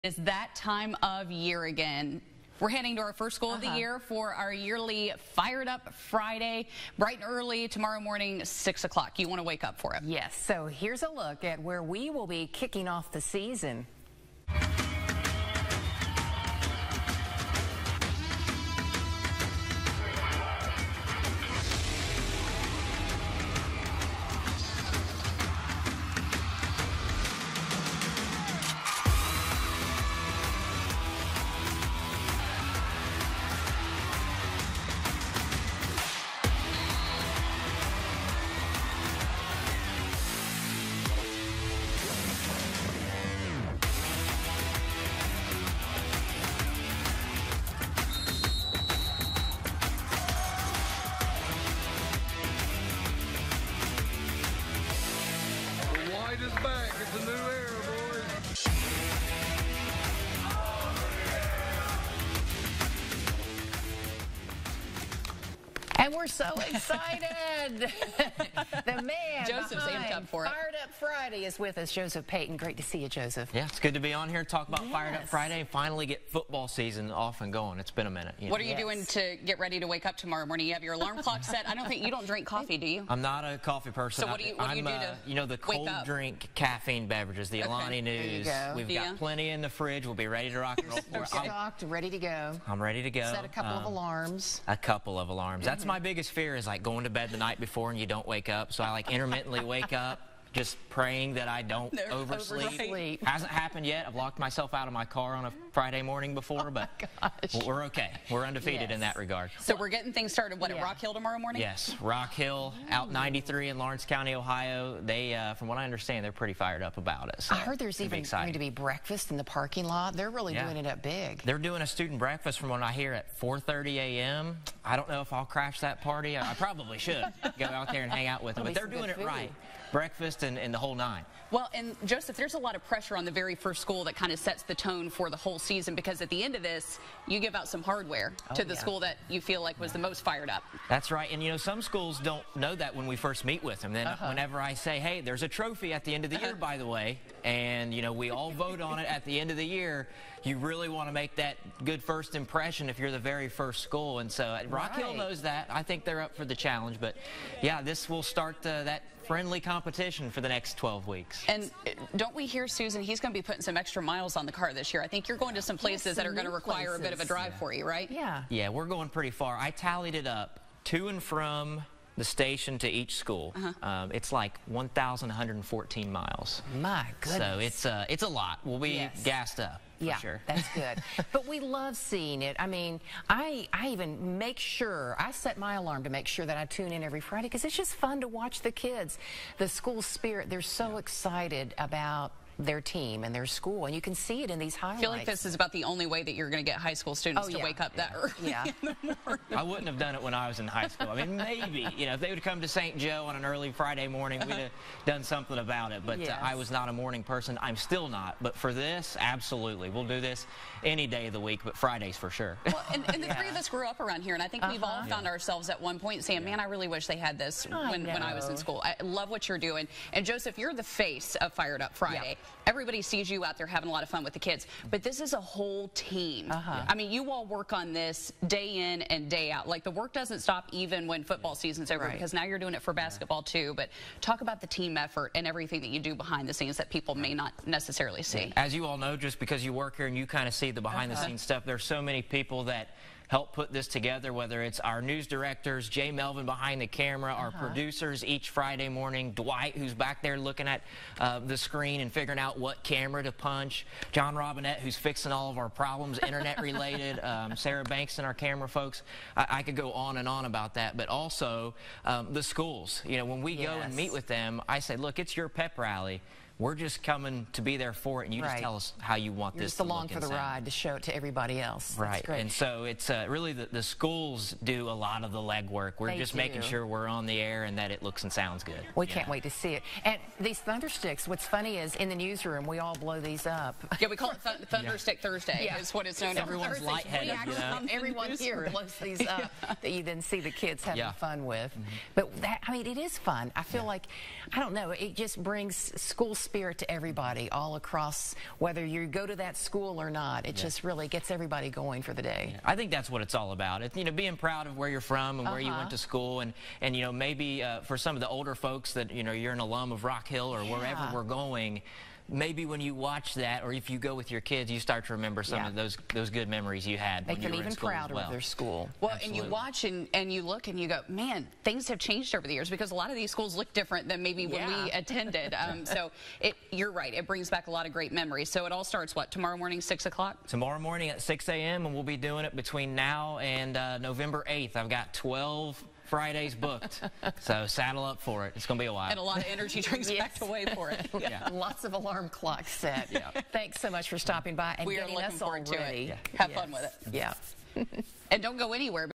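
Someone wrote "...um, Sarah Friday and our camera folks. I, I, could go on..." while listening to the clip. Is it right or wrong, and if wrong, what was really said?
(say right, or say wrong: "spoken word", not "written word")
wrong: "Banks", not "Friday".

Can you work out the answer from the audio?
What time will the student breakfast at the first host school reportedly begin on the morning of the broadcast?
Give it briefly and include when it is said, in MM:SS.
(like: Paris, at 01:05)
4:30 a.m., at 02:03.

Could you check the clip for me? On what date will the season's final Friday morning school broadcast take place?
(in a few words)
November 8th.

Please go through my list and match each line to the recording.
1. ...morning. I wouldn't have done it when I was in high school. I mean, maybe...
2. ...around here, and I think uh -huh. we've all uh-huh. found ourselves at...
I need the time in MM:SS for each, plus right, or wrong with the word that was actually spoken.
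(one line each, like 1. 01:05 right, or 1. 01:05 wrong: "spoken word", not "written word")
1. 03:19 right
2. 03:33 right.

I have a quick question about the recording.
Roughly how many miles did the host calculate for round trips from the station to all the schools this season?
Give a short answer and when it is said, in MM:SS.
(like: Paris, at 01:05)
1,114 miles, at 02:54.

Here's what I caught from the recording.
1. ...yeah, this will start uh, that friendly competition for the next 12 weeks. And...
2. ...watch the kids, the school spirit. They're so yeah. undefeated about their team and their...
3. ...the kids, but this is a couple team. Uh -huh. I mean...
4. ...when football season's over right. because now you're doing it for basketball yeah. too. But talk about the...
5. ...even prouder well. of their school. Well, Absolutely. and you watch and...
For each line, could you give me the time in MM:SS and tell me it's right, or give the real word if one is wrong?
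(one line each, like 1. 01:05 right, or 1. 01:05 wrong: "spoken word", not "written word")
1. 02:37 right
2. 03:08 wrong: "excited", not "undefeated"
3. 03:44 wrong: "whole", not "couple"
4. 03:51 right
5. 05:17 right.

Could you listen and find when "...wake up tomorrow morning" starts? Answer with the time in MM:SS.
01:19.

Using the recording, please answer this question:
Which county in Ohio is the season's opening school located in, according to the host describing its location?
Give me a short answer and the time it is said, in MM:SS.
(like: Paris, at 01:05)
Lawrence County, at 01:53.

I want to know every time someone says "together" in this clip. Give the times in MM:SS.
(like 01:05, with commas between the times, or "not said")
04:03.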